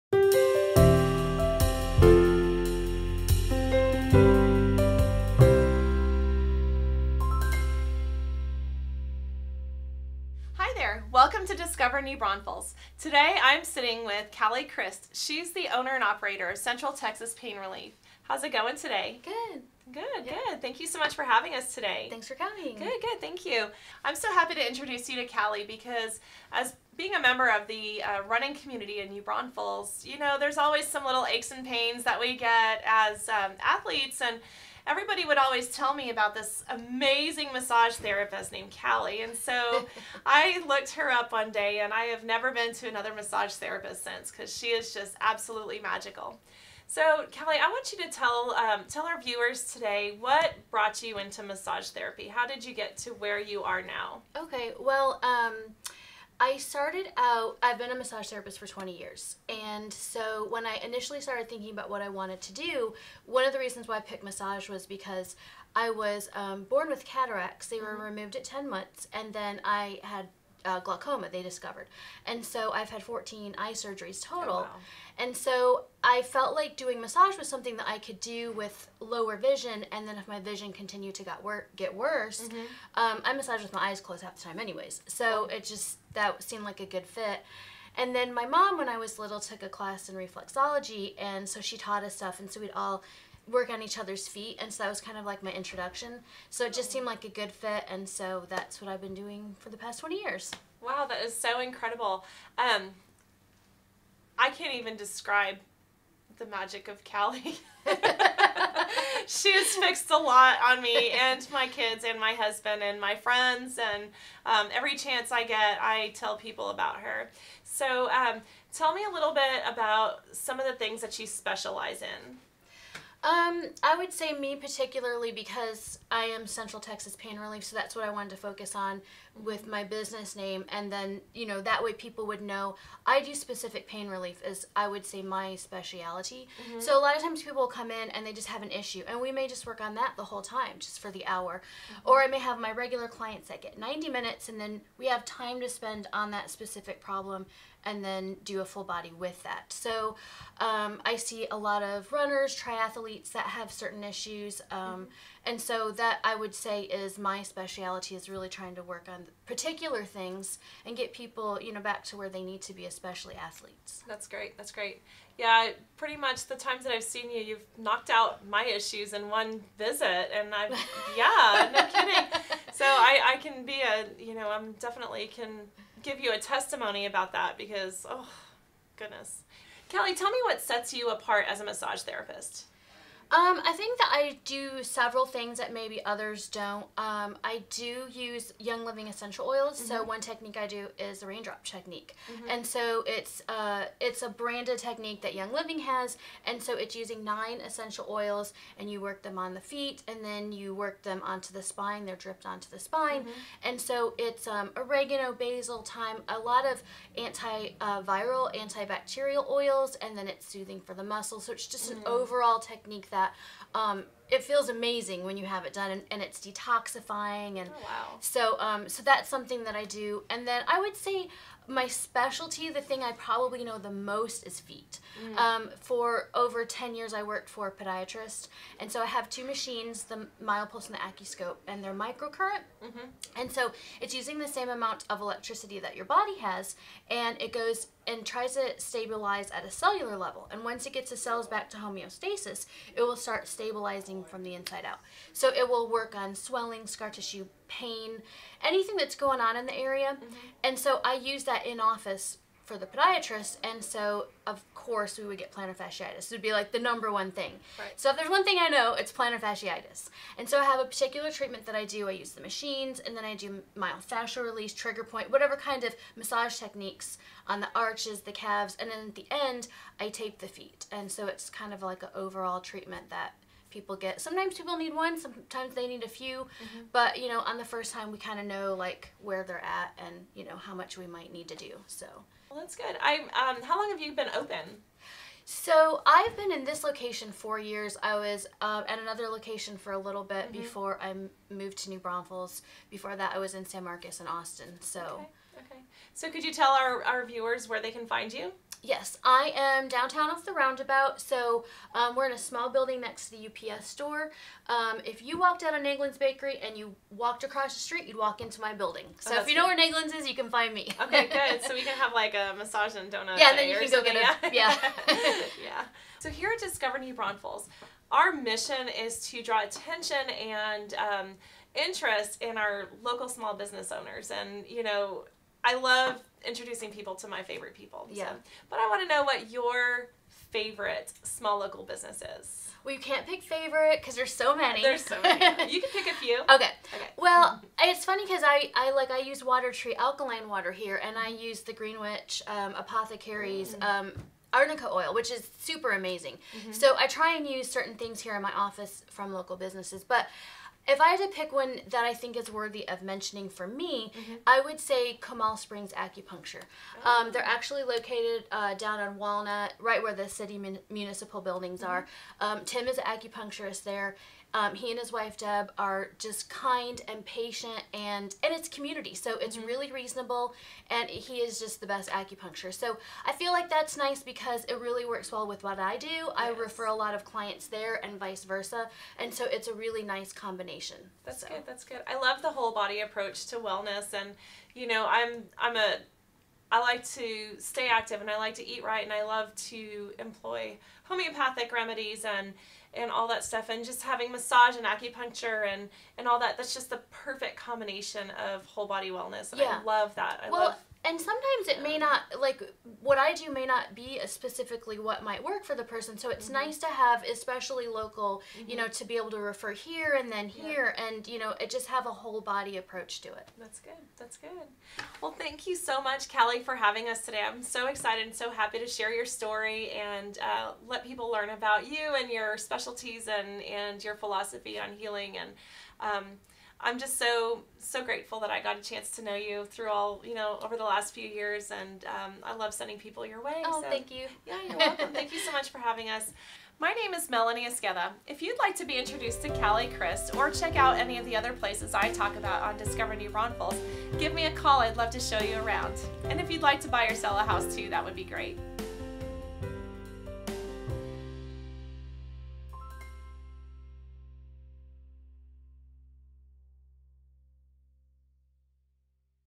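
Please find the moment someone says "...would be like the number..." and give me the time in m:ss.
4:16.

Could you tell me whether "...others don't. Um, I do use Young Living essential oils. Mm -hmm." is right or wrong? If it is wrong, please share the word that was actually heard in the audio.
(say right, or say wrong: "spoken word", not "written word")
right.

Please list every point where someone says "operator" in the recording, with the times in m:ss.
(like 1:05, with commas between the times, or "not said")
0:16.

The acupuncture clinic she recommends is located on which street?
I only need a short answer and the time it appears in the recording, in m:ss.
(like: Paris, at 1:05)
Walnut, at 5:59.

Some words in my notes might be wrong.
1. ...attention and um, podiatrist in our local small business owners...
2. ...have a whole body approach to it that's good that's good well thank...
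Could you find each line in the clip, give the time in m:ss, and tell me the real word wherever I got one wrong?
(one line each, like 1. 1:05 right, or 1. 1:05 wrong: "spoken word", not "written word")
1. 5:19 wrong: "interest", not "podiatrist"
2. 6:51 right.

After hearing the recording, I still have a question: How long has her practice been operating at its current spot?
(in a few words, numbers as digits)
4 years.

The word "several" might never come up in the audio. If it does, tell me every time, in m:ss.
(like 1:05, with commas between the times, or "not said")
3:04.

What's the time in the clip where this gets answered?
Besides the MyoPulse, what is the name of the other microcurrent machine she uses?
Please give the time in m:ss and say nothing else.
3:50.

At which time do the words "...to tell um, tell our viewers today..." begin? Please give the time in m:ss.
0:48.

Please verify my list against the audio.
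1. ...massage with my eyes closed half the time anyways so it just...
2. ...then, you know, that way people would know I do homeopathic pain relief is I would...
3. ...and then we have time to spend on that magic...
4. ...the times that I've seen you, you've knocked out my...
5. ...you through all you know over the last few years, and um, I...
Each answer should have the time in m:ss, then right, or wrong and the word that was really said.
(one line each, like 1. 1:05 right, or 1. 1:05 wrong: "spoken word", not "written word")
1. 1:23 right
2. 2:10 wrong: "specific", not "homeopathic"
3. 2:24 wrong: "specific", not "magic"
4. 2:46 right
5. 7:09 right.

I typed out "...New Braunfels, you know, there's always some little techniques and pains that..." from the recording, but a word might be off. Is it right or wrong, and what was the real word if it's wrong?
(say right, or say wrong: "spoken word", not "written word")
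wrong: "aches", not "techniques".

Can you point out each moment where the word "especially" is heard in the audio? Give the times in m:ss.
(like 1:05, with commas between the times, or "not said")
2:42, 6:47.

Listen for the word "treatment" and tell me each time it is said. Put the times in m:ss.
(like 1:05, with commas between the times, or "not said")
4:21, 4:32.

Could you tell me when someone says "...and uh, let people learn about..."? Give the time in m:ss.
6:59.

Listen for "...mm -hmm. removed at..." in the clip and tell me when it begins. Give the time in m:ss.
1:07.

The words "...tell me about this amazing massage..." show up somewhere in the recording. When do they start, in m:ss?
0:35.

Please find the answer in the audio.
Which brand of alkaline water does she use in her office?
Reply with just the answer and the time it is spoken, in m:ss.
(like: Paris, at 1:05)
Watertree, at 5:39.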